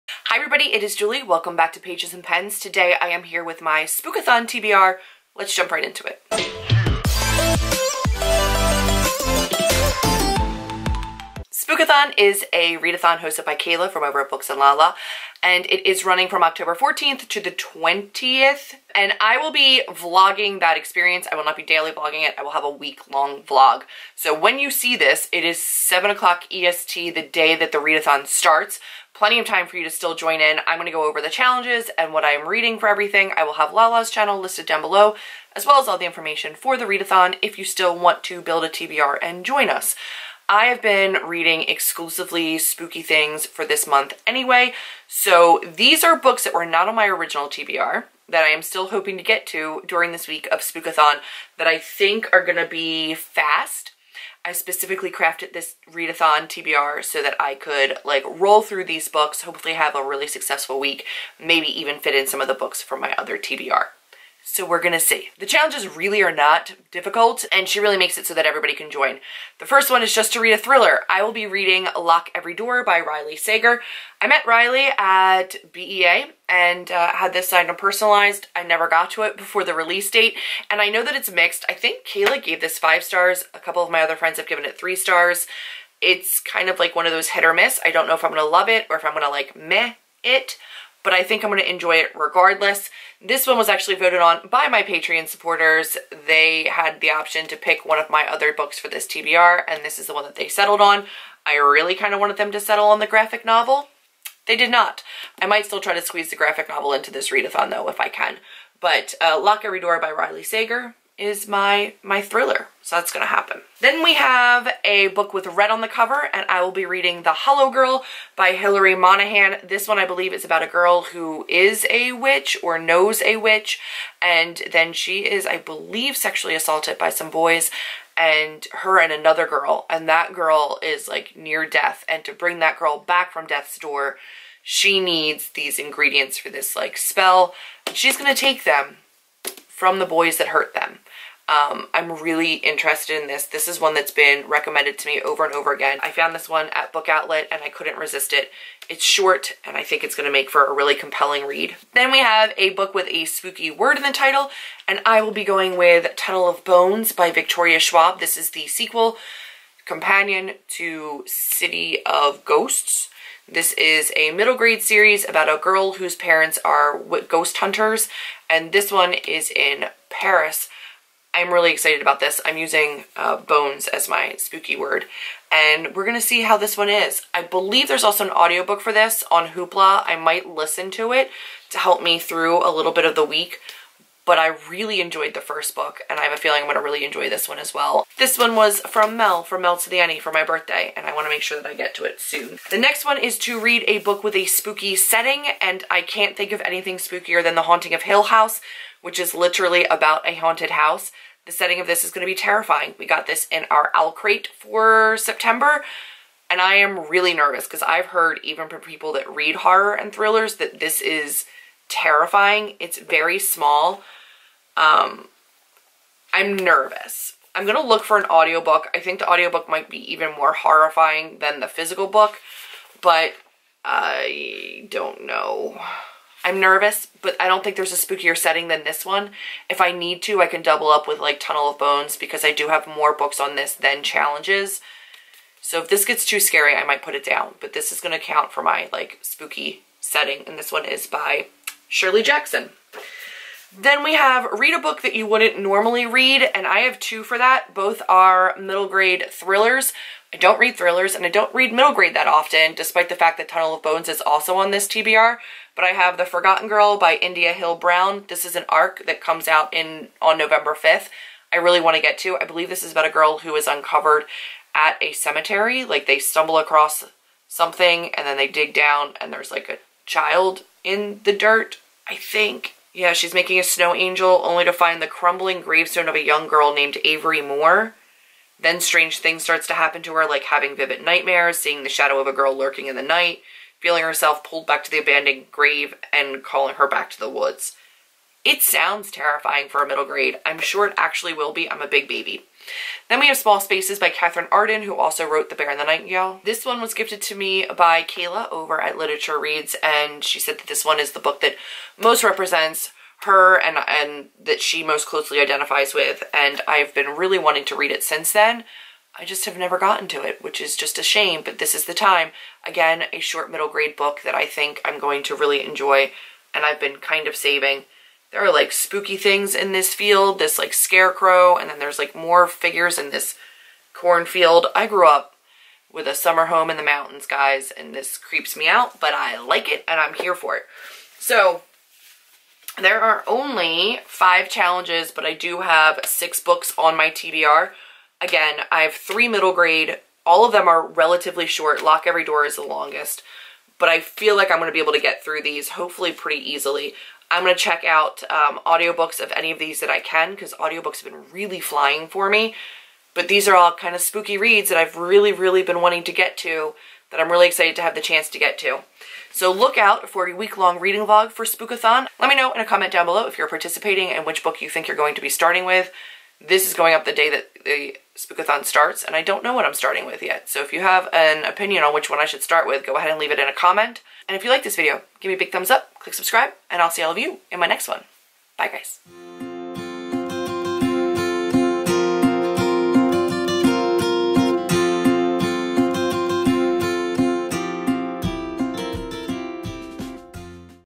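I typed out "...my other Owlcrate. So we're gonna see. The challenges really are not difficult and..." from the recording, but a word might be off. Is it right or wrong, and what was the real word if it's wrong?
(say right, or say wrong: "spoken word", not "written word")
wrong: "TBR", not "Owlcrate".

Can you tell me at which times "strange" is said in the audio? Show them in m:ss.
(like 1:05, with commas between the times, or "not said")
4:38.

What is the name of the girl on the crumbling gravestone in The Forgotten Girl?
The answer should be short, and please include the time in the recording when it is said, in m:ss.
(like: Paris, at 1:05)
Avery Moore, at 4:37.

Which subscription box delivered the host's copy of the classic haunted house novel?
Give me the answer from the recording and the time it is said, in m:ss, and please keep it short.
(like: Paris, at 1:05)
Owlcrate, at 3:23.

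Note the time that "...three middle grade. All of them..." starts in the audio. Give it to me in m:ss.
5:38.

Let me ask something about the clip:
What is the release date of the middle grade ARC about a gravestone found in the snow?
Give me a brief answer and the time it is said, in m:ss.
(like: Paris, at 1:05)
November 5th, at 4:20.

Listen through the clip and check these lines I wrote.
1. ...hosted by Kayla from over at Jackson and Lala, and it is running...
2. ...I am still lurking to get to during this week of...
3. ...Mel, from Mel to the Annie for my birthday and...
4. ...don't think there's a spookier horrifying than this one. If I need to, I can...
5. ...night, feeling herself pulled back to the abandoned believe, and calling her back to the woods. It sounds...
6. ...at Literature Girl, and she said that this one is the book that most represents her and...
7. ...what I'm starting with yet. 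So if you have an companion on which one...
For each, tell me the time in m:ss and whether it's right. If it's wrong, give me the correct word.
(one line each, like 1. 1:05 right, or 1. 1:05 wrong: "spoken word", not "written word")
1. 0:13 wrong: "Books", not "Jackson"
2. 0:48 wrong: "hoping", not "lurking"
3. 3:09 right
4. 3:47 wrong: "setting", not "horrifying"
5. 4:43 wrong: "grave", not "believe"
6. 4:58 wrong: "Reads", not "Girl"
7. 6:09 wrong: "opinion", not "companion".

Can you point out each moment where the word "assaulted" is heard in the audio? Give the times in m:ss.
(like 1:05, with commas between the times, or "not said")
2:06.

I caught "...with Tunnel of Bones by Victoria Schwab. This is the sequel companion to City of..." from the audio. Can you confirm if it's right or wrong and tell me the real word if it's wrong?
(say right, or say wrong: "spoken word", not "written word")
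right.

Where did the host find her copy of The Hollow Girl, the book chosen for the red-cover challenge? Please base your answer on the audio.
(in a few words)
Book Outlet.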